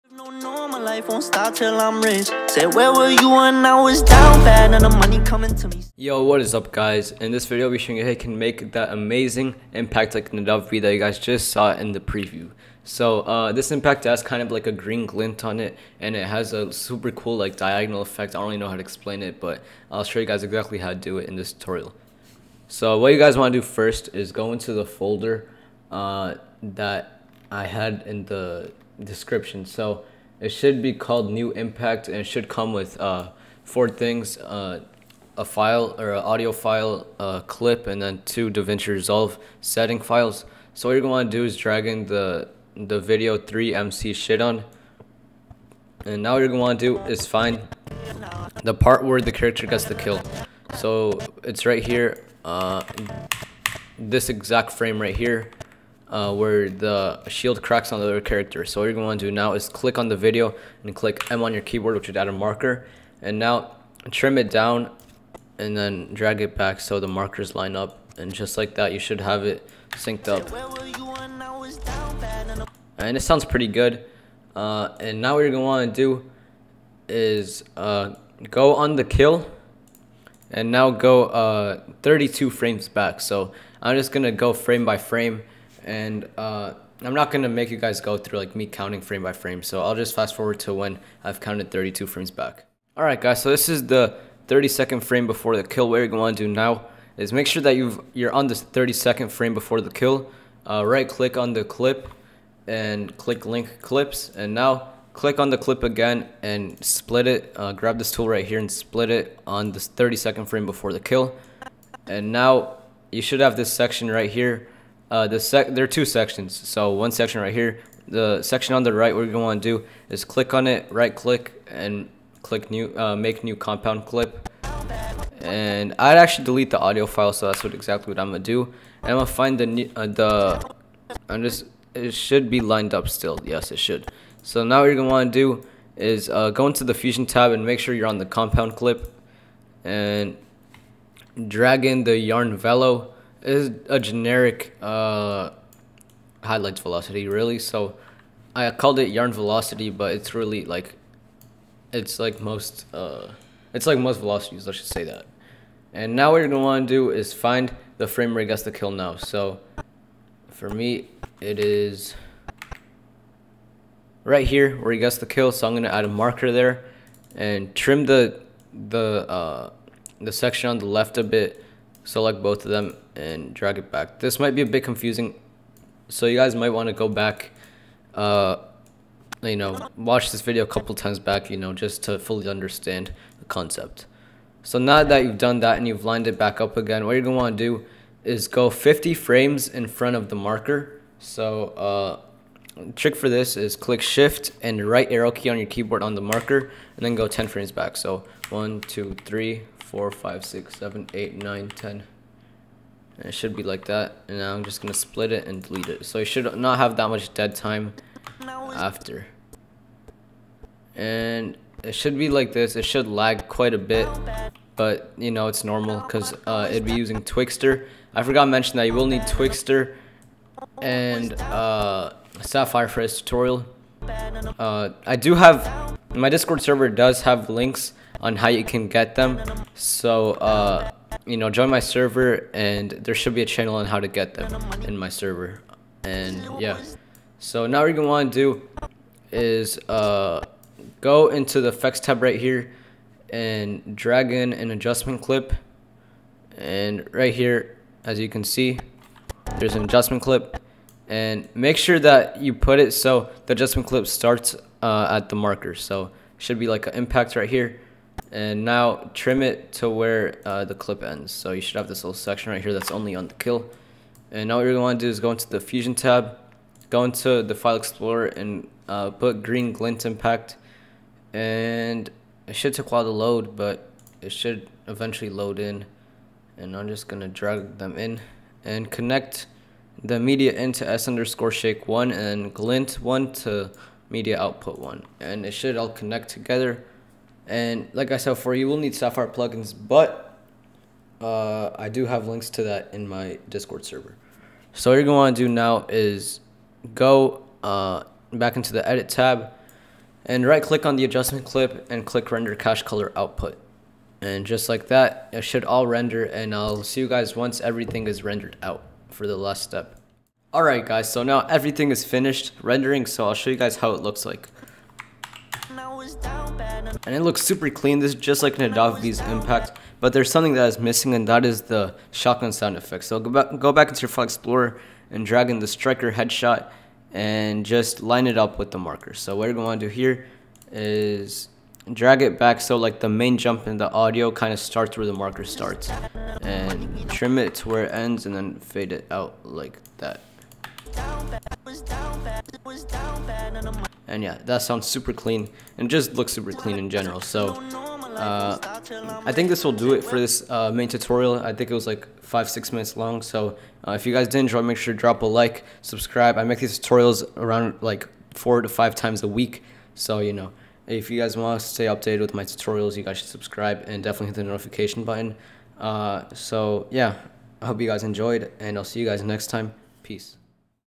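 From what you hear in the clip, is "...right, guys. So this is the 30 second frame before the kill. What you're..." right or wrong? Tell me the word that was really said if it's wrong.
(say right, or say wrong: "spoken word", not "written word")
right.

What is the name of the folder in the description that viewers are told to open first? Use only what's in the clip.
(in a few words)
New Impact.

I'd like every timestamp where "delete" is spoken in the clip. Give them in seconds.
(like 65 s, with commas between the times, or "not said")
126 s, 205 s.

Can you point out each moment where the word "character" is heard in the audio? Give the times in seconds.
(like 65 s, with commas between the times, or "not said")
49 s, 58 s.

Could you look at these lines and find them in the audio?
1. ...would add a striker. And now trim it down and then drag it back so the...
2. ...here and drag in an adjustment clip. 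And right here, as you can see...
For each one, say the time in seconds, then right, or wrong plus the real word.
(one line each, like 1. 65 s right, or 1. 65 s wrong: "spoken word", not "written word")
1. 62 s wrong: "marker", not "striker"
2. 242 s right.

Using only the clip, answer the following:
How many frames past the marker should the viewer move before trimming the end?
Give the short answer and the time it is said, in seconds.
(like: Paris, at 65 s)
50, at 188 s.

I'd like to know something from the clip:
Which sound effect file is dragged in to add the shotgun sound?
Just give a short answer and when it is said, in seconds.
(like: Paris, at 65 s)
striker headshot, at 325 s.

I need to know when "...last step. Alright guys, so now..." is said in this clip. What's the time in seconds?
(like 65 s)
309 s.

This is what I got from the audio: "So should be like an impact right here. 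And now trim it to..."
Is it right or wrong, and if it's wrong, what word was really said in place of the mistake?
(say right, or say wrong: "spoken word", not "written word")
right.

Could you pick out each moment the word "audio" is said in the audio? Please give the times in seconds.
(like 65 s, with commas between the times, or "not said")
36 s, 126 s, 333 s.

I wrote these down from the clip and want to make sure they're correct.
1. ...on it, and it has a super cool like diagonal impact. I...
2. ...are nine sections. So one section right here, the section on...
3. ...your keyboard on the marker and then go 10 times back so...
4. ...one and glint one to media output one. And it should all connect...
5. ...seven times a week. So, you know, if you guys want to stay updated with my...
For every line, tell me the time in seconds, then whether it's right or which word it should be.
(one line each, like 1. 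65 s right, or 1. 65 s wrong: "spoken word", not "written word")
1. 15 s wrong: "effect", not "impact"
2. 115 s wrong: "two", not "nine"
3. 195 s wrong: "frames", not "times"
4. 281 s right
5. 358 s wrong: "five", not "seven".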